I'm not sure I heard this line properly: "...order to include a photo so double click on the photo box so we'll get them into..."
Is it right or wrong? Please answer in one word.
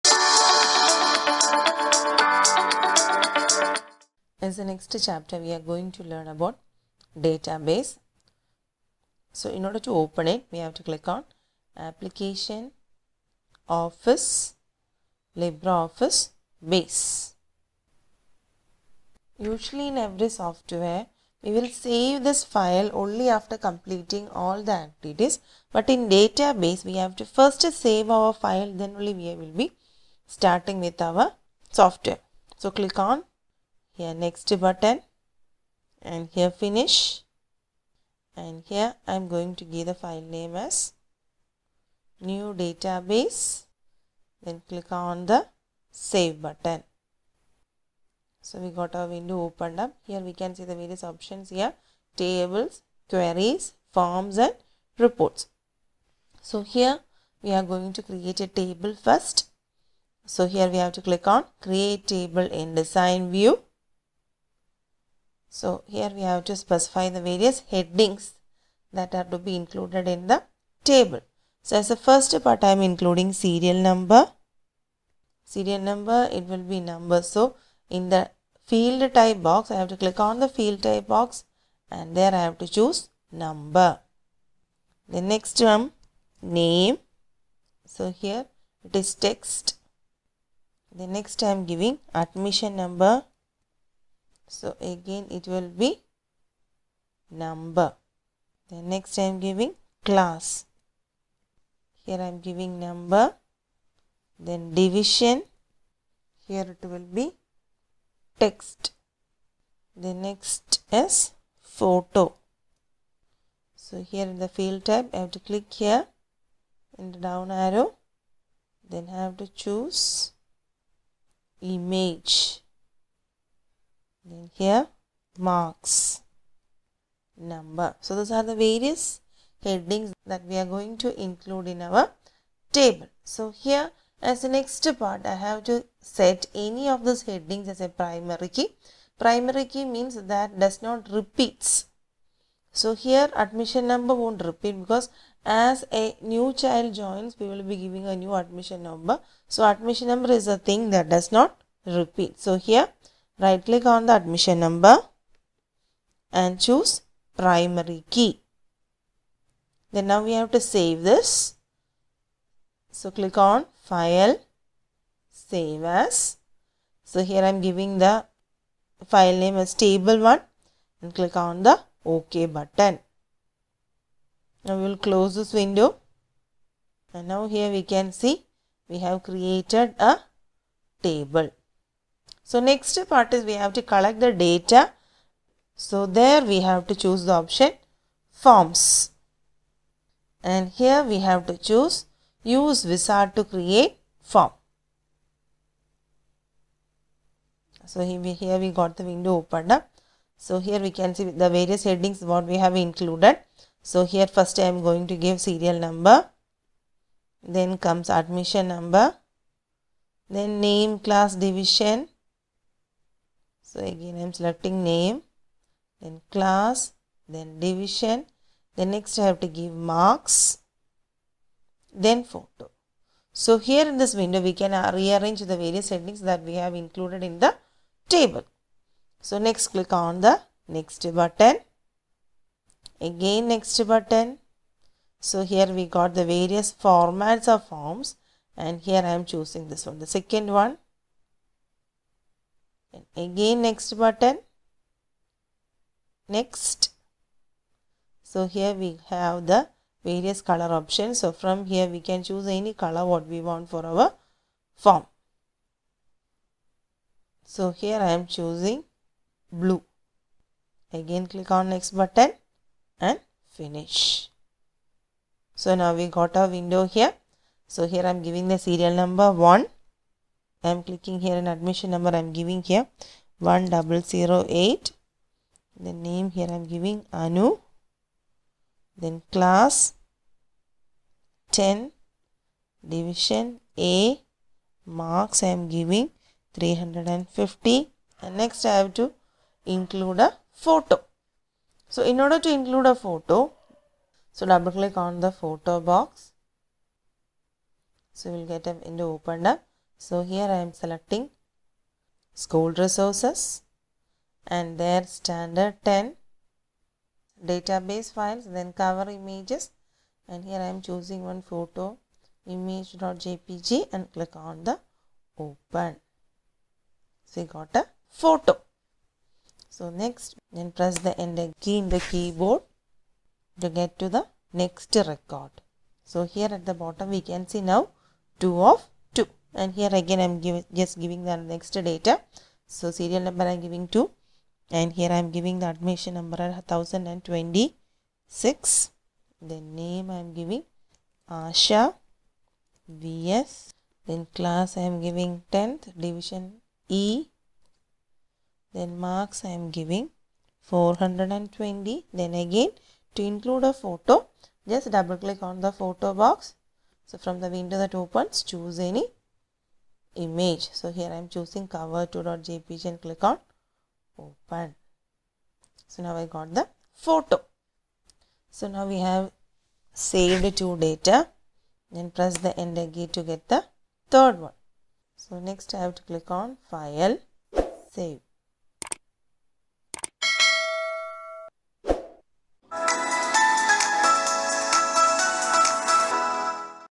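right.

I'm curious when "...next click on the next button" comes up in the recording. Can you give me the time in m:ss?
3:49.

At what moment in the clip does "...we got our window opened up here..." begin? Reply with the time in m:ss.
0:48.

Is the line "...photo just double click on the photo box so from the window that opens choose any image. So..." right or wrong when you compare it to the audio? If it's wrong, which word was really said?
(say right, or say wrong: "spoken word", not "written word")
right.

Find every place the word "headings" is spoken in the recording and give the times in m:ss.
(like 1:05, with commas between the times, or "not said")
1:07, 2:09, 2:17, 3:21.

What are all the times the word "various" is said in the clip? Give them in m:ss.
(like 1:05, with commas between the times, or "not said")
0:50, 1:07, 2:08, 3:21, 3:45, 3:56, 4:10.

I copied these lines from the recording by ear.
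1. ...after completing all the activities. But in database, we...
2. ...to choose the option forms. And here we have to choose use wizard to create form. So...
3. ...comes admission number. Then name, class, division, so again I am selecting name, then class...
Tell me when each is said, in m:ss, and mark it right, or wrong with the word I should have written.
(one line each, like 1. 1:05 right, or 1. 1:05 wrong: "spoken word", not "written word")
1. 0:23 right
2. 3:06 right
3. 3:27 right.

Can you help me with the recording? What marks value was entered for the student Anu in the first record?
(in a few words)
350.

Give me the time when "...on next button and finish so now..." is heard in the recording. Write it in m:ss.
4:21.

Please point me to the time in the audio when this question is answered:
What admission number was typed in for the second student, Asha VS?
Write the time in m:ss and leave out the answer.
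5:36.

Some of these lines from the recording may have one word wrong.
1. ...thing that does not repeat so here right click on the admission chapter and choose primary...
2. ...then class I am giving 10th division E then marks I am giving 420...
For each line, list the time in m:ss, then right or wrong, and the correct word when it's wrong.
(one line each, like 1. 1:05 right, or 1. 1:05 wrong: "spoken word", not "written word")
1. 2:30 wrong: "number", not "chapter"
2. 5:44 right.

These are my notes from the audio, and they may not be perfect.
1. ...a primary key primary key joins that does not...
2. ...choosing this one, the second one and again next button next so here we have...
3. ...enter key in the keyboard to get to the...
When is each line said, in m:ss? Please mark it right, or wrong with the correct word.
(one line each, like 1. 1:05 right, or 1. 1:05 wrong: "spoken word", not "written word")
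1. 2:17 wrong: "means", not "joins"
2. 3:59 right
3. 5:21 right.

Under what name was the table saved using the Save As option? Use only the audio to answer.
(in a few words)
table 1.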